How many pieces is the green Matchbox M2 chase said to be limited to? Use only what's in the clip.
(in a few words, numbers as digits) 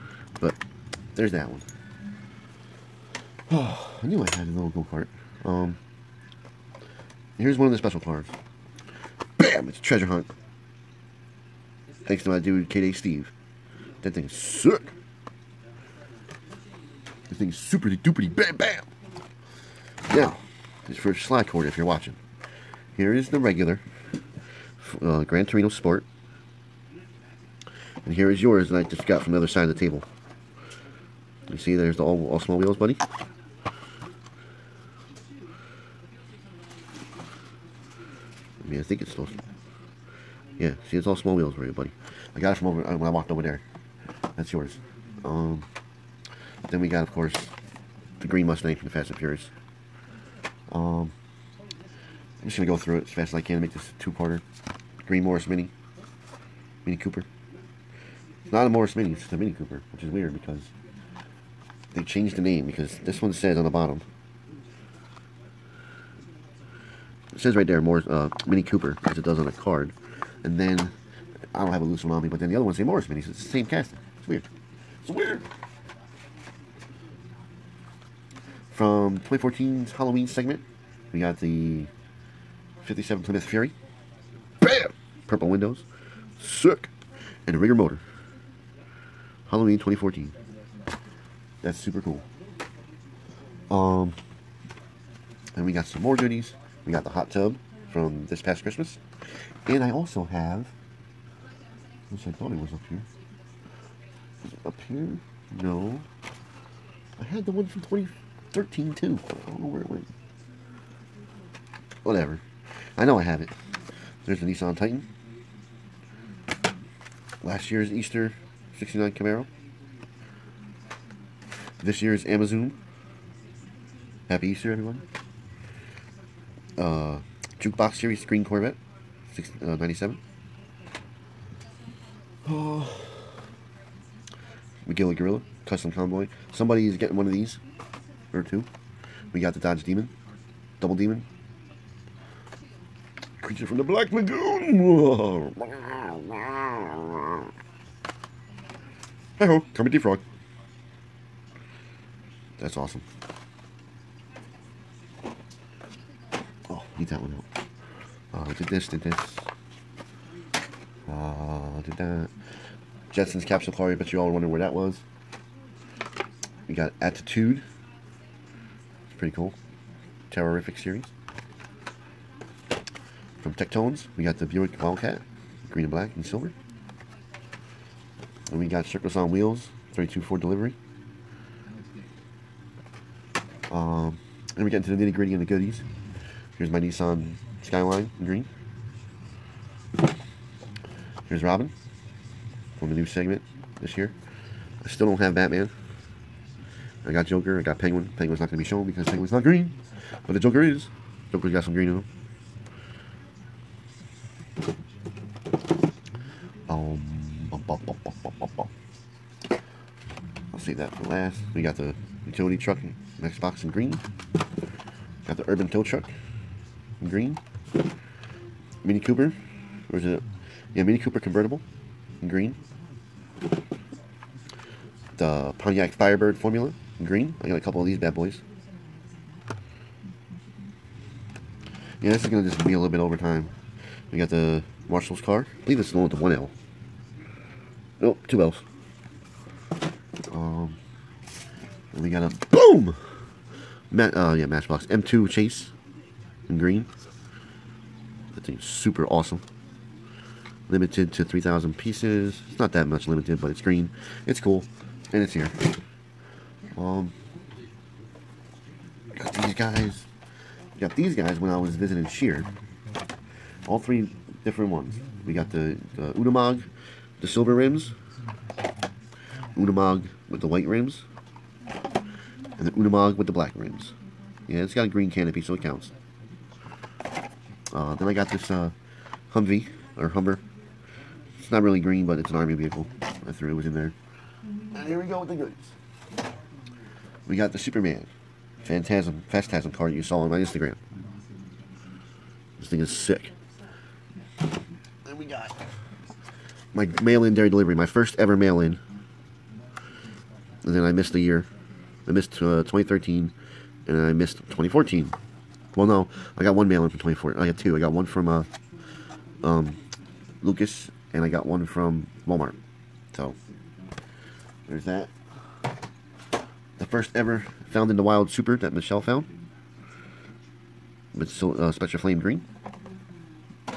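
3,000.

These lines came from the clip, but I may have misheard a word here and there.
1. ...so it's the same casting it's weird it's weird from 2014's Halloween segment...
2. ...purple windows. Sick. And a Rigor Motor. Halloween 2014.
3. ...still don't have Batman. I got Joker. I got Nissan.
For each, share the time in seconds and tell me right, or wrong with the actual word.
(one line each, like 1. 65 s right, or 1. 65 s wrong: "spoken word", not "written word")
1. 73 s right
2. 85 s right
3. 194 s wrong: "Penguin", not "Nissan".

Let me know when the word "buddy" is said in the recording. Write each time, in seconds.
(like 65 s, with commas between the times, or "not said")
32 s, 41 s.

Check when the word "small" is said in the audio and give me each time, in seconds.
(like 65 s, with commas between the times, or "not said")
32 s, 41 s.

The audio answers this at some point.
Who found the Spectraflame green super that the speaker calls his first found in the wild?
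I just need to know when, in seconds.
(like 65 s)
318 s.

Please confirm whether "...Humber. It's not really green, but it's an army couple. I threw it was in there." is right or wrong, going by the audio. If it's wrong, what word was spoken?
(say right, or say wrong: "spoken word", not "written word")
wrong: "vehicle", not "couple".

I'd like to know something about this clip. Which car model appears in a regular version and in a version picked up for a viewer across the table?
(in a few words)
Gran Torino Sport.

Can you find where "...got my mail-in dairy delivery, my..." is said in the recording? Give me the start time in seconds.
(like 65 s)
295 s.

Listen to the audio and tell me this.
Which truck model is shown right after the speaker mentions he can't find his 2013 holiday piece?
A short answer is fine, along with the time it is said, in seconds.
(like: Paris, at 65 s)
Nissan Titan, at 114 s.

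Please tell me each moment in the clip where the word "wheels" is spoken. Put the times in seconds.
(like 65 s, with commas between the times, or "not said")
32 s, 41 s, 179 s.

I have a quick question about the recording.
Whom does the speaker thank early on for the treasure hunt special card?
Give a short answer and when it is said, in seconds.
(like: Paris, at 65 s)
K-Day Steve, at 12 s.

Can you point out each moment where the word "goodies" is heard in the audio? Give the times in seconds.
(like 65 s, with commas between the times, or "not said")
96 s, 185 s, 285 s.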